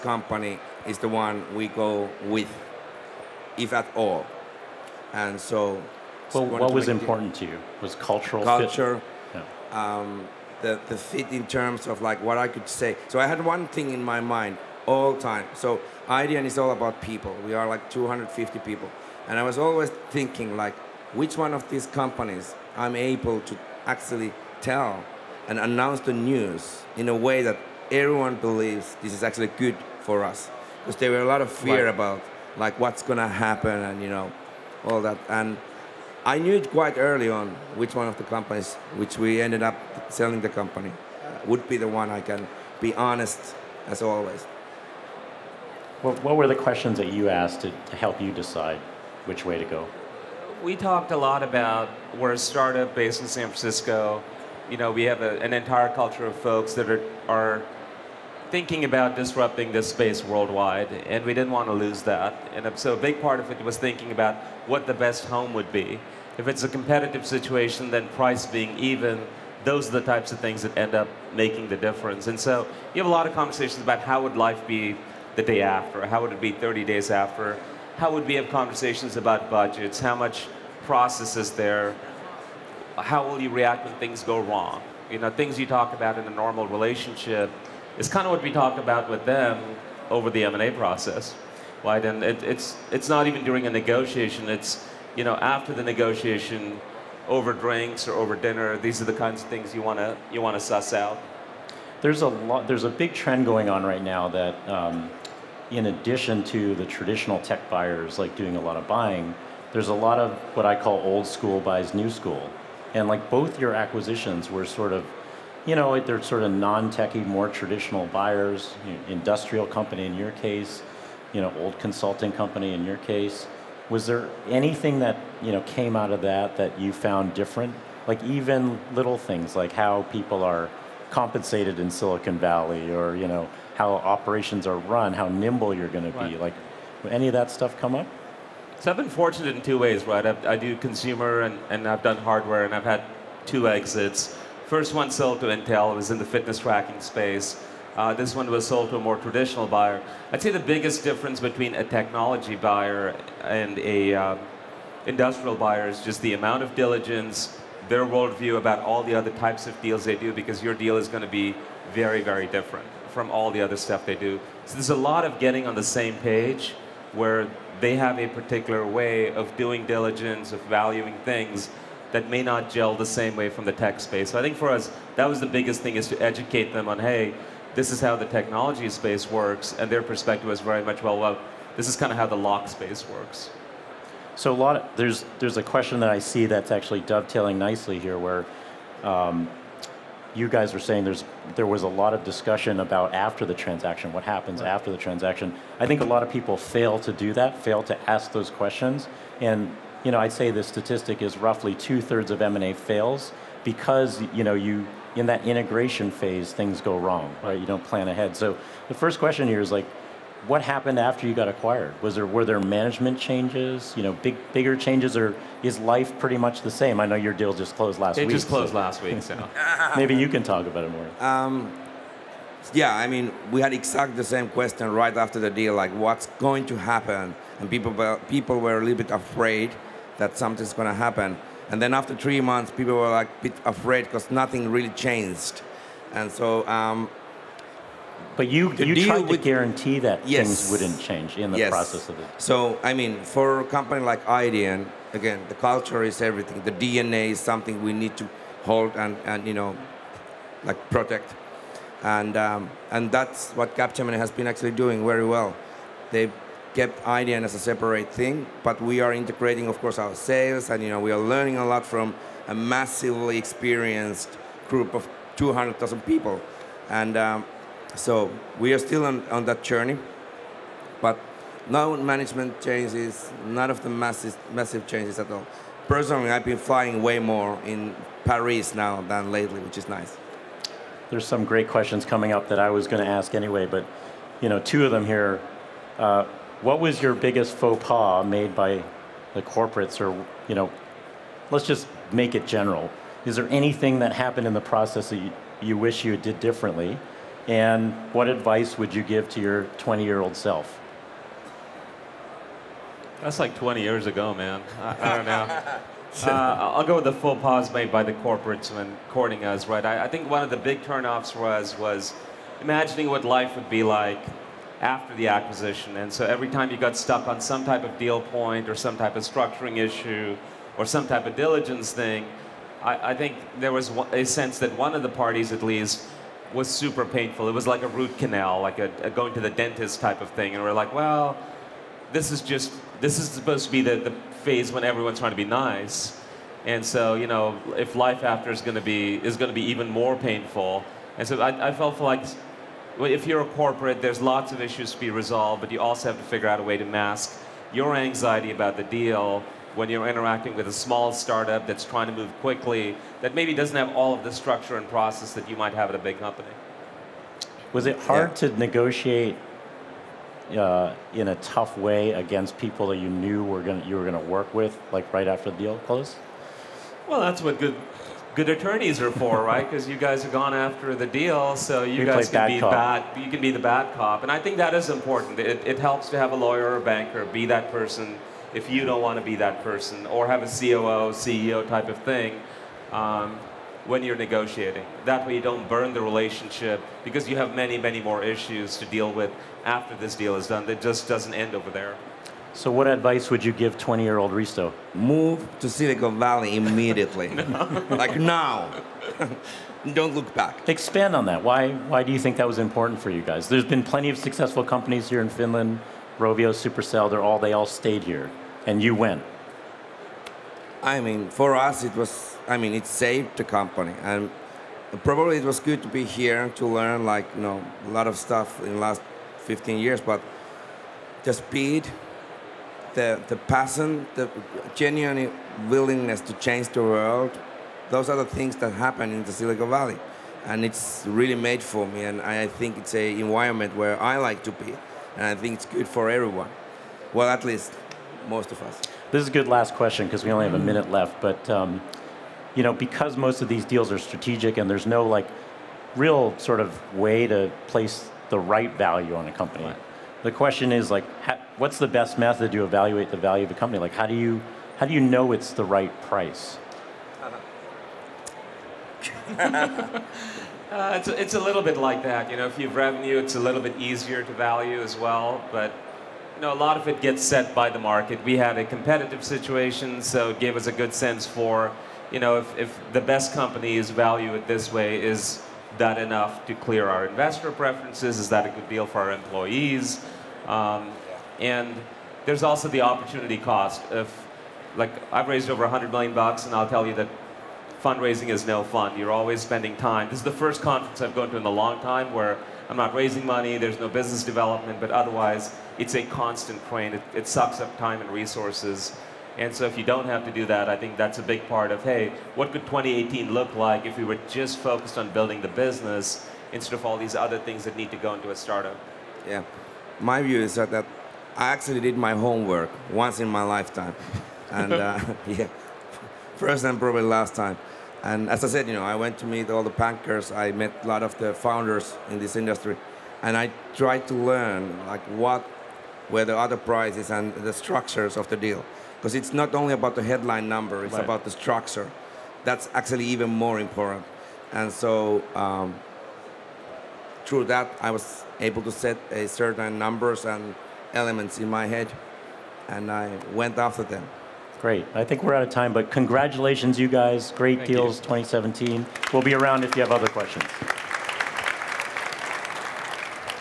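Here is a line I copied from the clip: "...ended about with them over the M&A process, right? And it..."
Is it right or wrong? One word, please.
wrong.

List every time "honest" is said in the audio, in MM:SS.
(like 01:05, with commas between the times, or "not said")
00:42.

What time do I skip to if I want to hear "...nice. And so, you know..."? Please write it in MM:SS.
05:35.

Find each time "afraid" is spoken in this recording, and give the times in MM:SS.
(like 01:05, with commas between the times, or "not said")
03:49, 03:53.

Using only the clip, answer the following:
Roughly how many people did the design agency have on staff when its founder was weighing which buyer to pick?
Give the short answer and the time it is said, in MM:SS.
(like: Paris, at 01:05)
250, at 00:17.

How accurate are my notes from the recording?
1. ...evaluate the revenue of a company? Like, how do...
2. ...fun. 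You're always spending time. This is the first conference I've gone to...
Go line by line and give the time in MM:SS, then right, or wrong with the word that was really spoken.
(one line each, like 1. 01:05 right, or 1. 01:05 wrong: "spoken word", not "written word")
1. 07:32 wrong: "value", not "revenue"
2. 08:08 right.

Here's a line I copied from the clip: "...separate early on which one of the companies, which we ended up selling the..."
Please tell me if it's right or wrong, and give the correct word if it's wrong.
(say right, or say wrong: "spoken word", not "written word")
wrong: "quite", not "separate".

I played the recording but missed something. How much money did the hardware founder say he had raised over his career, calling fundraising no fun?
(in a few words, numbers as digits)
over 100 million.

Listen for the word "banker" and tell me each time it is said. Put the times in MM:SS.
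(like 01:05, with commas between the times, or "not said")
06:16, 08:39.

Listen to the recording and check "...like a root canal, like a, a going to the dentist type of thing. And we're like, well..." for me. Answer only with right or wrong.
right.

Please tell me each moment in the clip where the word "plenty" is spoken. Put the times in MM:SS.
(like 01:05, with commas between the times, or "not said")
06:43.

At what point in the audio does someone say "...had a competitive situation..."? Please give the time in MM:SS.
07:48.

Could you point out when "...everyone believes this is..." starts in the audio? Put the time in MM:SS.
00:27.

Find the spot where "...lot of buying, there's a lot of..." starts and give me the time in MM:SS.
01:48.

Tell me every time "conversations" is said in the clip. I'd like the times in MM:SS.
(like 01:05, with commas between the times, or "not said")
01:13, 01:18.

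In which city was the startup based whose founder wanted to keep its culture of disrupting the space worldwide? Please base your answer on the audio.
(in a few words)
San Francisco.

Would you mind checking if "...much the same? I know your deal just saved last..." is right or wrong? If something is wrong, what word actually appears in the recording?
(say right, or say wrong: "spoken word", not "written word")
wrong: "closed", not "saved".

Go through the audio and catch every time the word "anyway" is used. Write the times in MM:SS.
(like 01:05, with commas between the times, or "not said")
04:43.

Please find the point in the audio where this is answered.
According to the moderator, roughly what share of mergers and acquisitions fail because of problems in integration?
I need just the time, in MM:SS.
03:21.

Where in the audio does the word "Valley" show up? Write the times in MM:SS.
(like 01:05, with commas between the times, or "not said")
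02:12, 06:36, 07:09.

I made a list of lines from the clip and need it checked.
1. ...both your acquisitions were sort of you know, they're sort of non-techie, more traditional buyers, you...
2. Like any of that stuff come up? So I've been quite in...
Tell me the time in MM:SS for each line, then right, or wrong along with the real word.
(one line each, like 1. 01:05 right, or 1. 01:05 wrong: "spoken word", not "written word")
1. 01:53 right
2. 02:16 wrong: "fortunate", not "quite".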